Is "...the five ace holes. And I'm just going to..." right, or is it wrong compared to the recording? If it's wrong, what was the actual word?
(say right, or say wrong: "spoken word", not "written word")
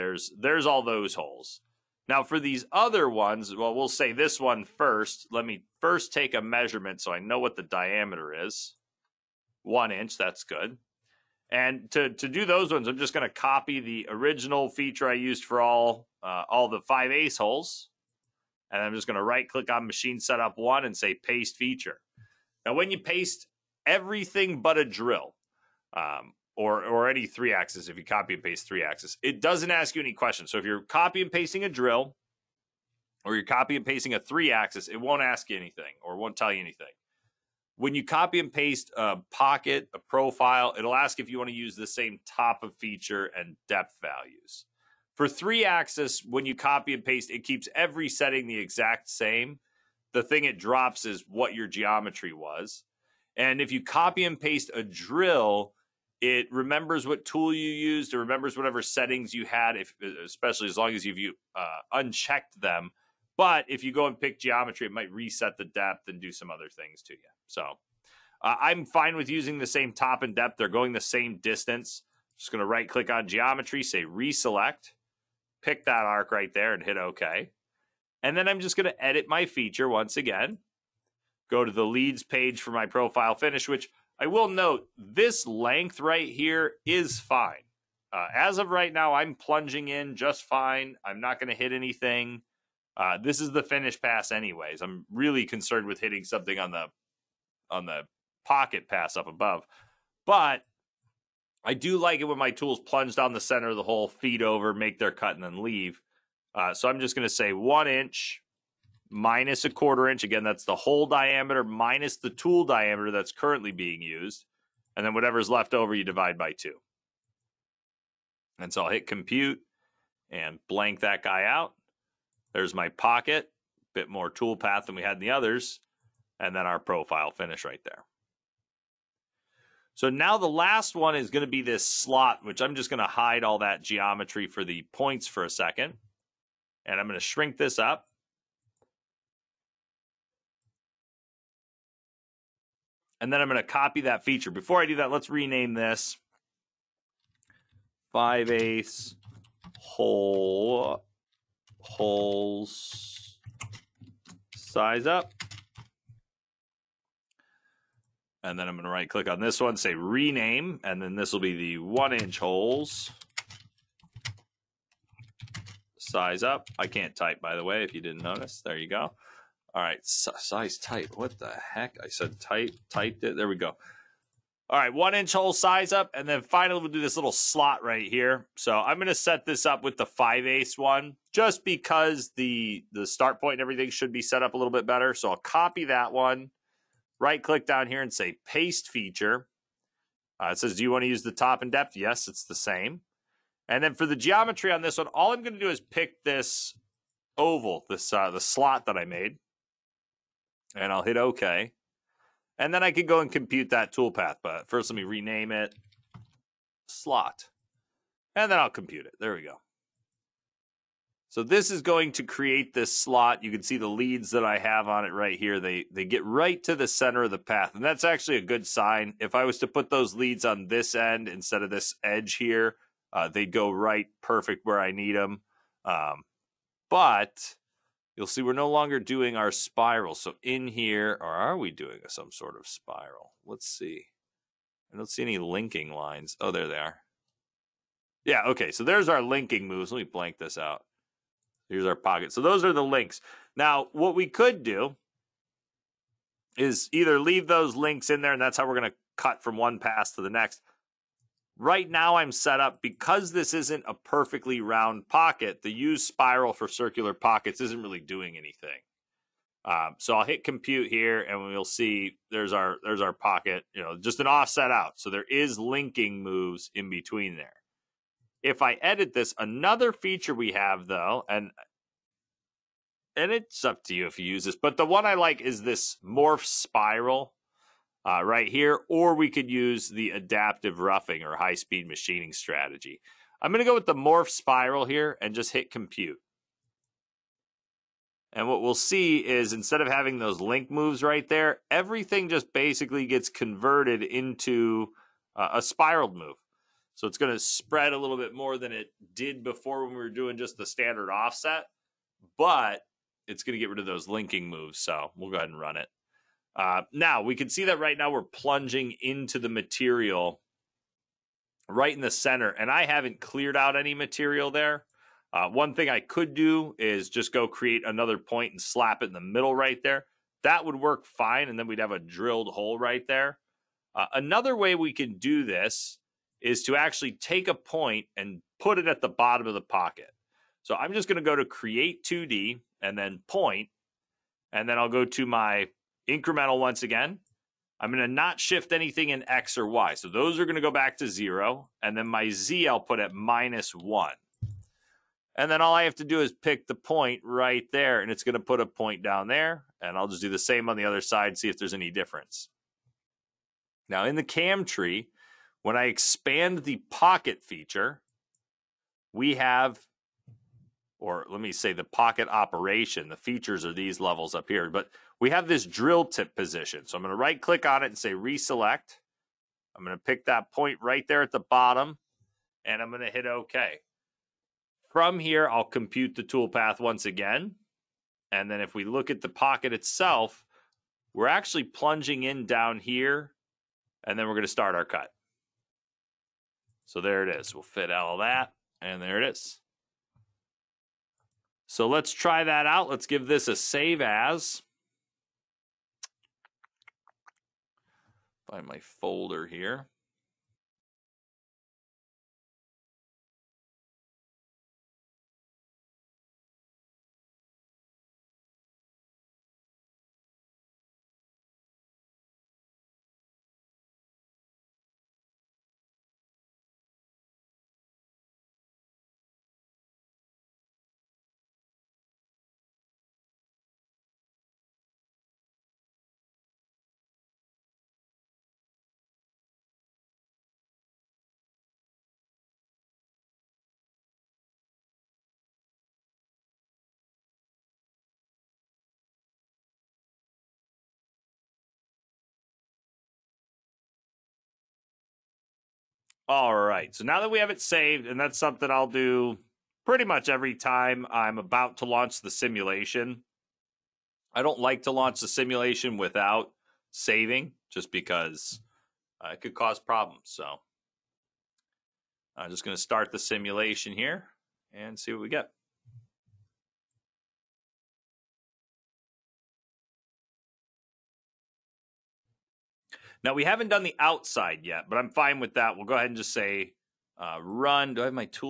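right.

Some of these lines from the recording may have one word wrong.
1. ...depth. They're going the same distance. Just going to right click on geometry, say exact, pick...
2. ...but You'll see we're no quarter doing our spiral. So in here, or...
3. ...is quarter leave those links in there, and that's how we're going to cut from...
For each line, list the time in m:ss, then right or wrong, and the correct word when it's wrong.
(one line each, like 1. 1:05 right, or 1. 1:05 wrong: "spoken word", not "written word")
1. 1:10 wrong: "reselect", not "exact"
2. 3:46 wrong: "longer", not "quarter"
3. 4:06 wrong: "either", not "quarter".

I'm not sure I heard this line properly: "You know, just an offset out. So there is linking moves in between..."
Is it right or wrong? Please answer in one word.
right.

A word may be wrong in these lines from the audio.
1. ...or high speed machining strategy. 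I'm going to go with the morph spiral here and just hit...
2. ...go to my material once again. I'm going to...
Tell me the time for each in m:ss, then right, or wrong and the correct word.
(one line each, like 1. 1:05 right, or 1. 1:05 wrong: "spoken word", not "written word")
1. 4:41 right
2. 5:34 wrong: "incremental", not "material".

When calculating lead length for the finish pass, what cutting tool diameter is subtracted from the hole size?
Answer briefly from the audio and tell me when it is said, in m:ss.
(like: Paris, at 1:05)
a quarter inch, at 1:49.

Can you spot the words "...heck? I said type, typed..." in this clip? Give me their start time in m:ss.
2:51.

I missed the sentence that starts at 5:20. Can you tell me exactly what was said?
That would work fine, and then we'd have a drilled hole right there.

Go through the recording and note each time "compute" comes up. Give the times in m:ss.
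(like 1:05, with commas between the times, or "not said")
1:59, 3:23, 3:28, 4:20, 4:45, 6:15.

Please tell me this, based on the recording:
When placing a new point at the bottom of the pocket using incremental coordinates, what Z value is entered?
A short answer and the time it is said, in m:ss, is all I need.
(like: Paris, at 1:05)
-1, at 5:43.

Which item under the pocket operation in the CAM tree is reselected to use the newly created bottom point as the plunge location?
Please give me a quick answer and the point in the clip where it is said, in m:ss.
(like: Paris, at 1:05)
drill tip position, at 6:05.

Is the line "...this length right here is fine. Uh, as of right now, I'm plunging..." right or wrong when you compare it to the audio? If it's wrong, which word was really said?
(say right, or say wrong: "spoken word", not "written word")
right.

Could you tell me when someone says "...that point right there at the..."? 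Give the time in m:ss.
6:10.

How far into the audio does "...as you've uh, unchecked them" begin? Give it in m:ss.
1:00.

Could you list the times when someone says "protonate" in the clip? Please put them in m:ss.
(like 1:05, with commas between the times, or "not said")
not said.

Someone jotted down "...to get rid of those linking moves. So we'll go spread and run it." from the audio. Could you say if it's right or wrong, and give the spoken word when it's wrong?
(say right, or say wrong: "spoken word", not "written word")
wrong: "ahead", not "spread".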